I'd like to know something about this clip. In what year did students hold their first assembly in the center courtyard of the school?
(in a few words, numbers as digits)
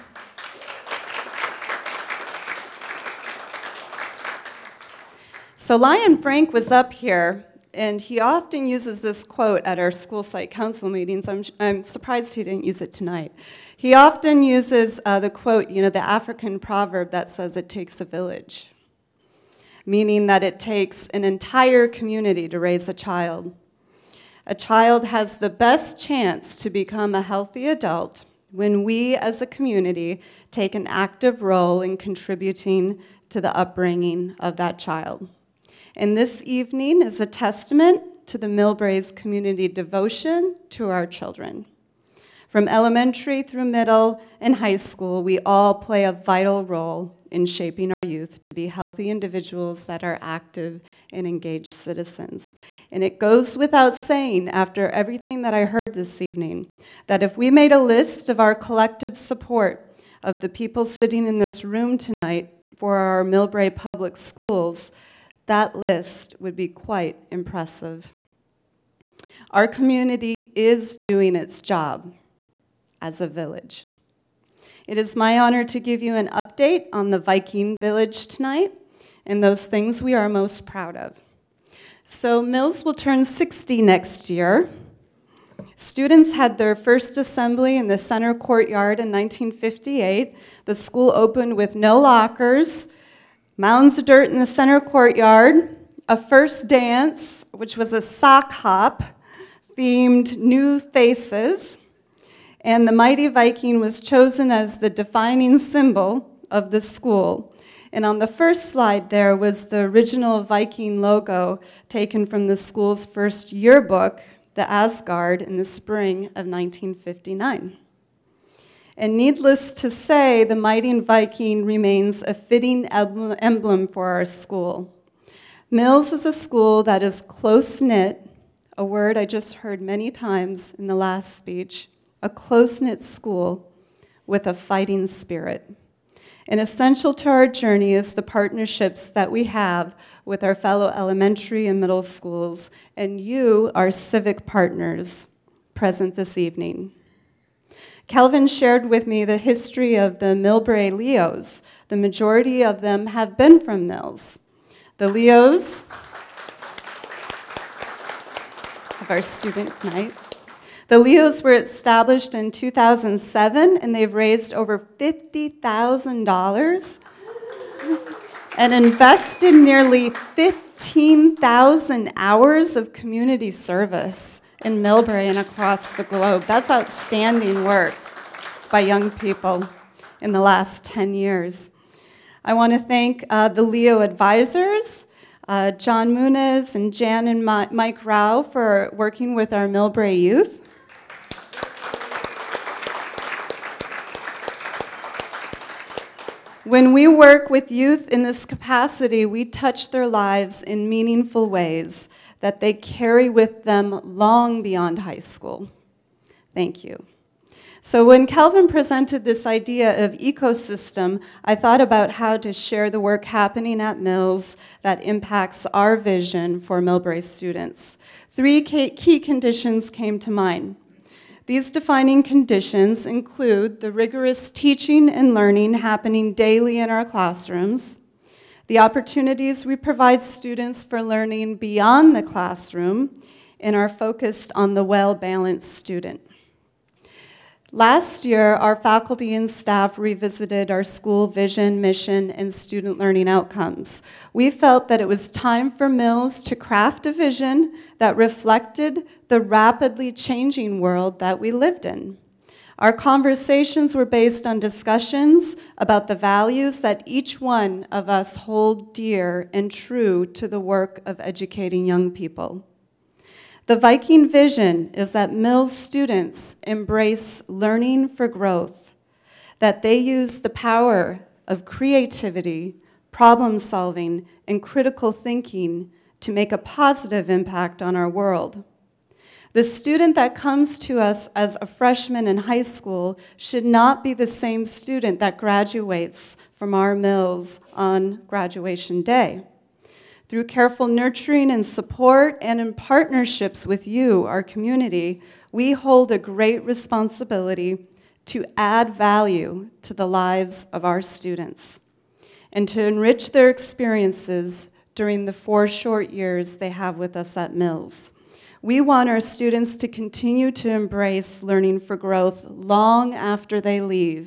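1958.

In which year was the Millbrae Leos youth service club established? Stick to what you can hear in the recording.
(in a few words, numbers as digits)
2007.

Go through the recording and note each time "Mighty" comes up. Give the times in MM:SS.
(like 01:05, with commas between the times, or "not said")
01:42, 02:00.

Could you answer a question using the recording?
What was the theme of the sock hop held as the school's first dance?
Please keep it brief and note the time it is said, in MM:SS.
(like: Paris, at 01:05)
New Faces, at 01:40.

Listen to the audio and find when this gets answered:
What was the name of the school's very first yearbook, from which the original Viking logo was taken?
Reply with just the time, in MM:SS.
01:54.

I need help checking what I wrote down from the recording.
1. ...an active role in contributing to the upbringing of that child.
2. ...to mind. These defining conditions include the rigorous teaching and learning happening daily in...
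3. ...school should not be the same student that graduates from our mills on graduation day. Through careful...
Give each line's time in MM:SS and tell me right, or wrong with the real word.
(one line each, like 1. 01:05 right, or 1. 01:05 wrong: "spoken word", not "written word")
1. 00:30 right
2. 03:40 right
3. 04:42 right.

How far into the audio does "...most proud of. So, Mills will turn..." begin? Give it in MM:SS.
01:20.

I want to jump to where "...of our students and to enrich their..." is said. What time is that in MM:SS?
05:00.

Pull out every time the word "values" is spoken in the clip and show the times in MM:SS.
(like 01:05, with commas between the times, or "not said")
04:16, 04:58.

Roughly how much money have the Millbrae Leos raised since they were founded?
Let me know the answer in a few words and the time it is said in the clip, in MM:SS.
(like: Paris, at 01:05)
$50,000, at 02:44.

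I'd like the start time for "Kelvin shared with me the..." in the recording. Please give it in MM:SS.
02:28.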